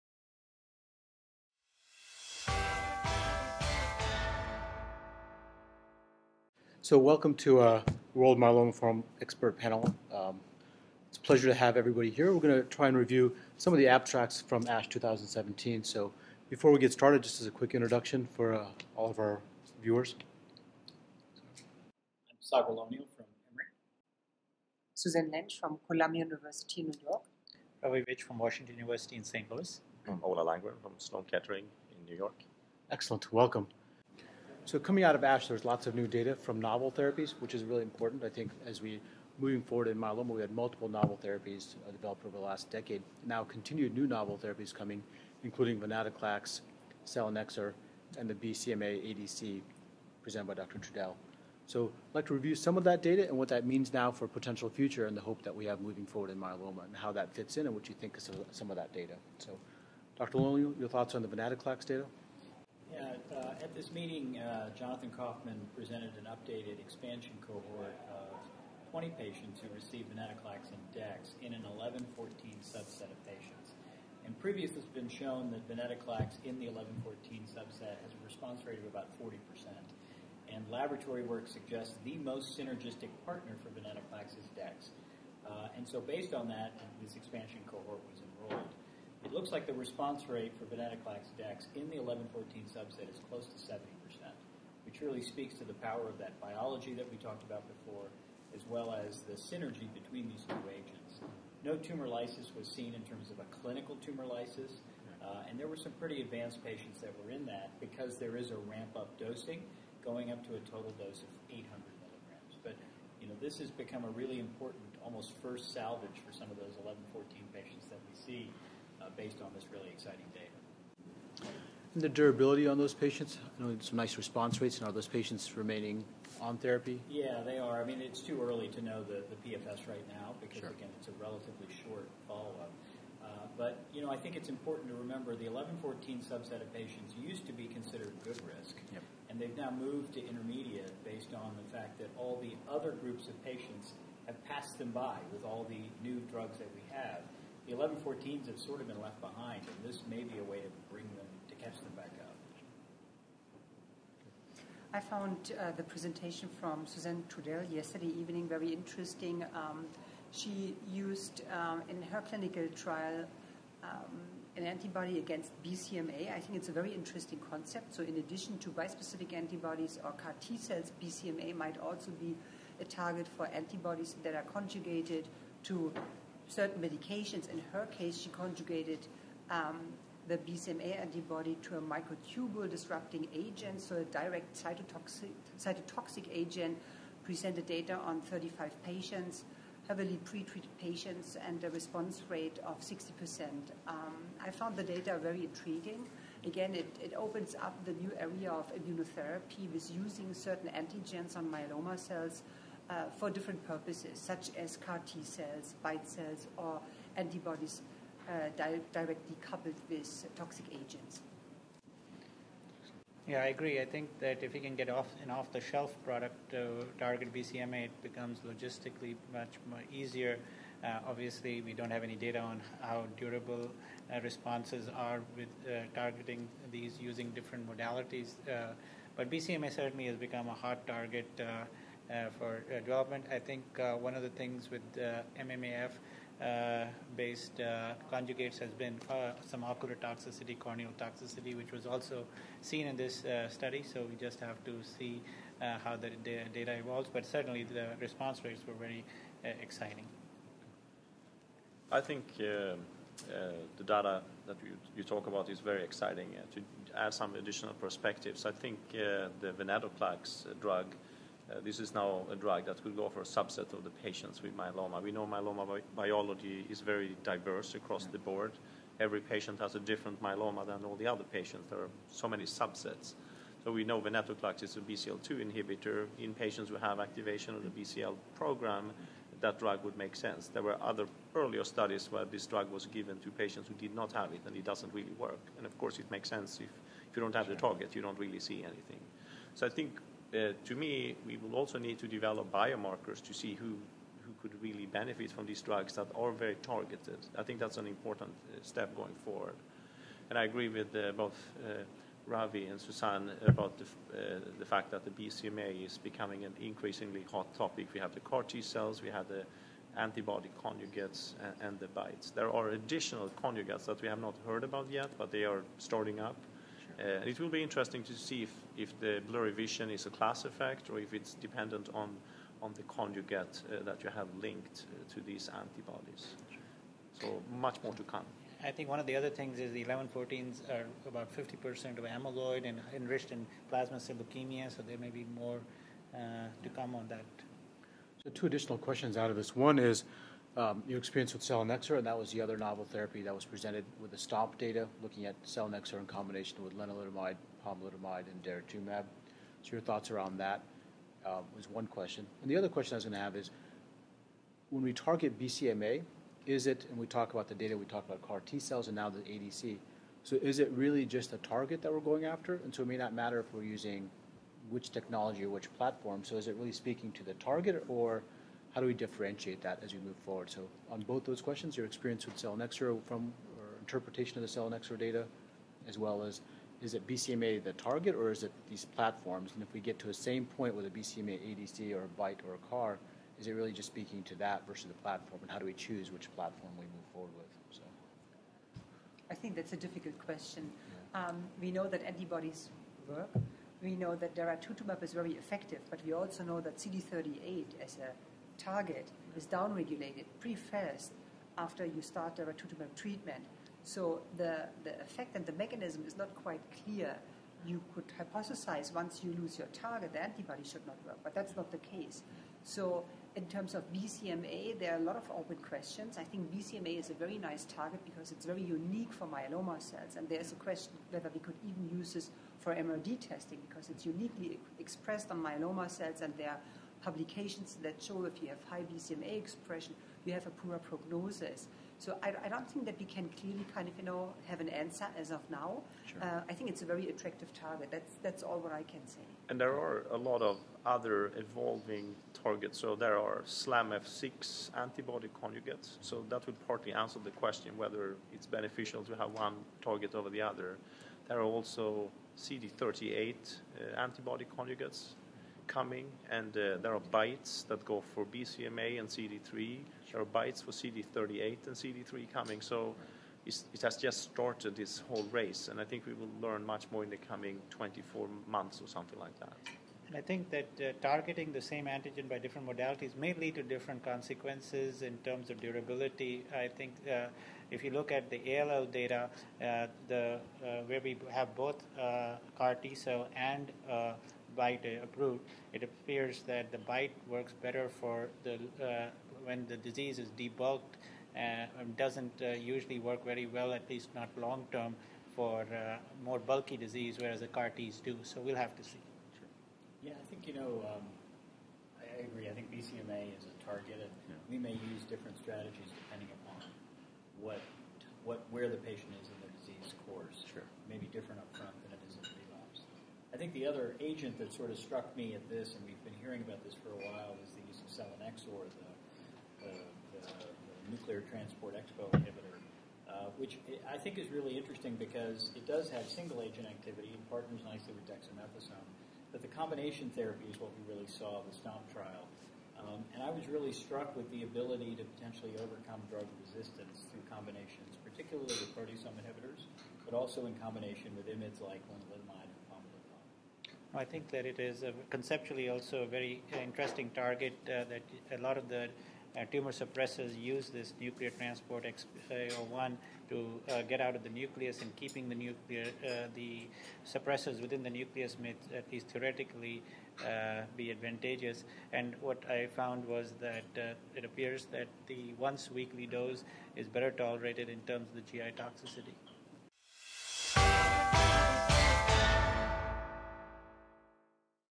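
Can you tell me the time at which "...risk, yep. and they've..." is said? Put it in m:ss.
2:18.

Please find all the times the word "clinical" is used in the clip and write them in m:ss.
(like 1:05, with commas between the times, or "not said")
1:43, 2:42.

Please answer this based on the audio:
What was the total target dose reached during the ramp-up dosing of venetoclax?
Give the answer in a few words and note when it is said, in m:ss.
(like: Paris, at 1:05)
800 milligrams, at 1:51.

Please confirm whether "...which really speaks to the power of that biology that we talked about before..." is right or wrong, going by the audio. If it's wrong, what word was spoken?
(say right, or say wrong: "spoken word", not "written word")
right.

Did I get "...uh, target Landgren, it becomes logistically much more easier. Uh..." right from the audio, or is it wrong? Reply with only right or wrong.
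wrong.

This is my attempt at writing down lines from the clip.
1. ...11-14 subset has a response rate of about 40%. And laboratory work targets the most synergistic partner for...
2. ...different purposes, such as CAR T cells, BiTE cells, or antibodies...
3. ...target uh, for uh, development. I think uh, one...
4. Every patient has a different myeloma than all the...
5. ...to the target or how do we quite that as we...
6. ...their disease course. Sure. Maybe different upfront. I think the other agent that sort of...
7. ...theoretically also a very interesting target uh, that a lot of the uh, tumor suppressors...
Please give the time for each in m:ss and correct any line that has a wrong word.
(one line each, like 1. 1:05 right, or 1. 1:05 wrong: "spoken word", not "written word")
1. 1:16 wrong: "suggests", not "targets"
2. 3:23 right
3. 3:50 right
4. 4:29 right
5. 6:07 wrong: "differentiate", not "quite"
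6. 8:29 right
7. 9:05 wrong: "conceptually", not "theoretically".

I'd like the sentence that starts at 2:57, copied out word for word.
In her case, she conjugated um, the BCMA antibody to a microtubule disrupting agent, so a direct cytotoxic, cytotoxic agent.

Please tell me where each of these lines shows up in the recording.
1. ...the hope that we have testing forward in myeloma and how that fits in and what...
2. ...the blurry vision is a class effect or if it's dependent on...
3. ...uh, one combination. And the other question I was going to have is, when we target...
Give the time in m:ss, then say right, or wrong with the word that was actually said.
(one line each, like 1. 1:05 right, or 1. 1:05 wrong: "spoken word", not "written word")
1. 0:55 wrong: "moving", not "testing"
2. 5:18 right
3. 5:51 wrong: "question", not "combination".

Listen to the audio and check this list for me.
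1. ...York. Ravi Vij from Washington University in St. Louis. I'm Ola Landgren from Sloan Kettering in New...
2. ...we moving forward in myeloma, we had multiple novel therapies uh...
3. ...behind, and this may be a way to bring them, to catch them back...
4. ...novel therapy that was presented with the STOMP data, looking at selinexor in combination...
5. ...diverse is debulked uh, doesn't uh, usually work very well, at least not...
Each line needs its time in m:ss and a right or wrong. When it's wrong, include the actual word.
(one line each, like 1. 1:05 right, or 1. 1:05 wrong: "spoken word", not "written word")
1. 0:27 right
2. 0:38 right
3. 2:29 right
4. 5:42 right
5. 8:09 wrong: "disease", not "diverse".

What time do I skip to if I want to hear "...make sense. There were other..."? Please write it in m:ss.
4:39.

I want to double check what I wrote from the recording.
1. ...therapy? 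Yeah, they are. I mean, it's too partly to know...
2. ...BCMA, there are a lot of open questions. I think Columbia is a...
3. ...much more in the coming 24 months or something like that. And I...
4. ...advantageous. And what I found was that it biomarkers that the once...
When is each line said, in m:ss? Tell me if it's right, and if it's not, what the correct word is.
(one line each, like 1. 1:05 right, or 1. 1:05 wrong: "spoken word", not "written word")
1. 2:06 wrong: "early", not "partly"
2. 6:53 wrong: "BCMA", not "Columbia"
3. 7:46 right
4. 9:20 wrong: "appears", not "biomarkers".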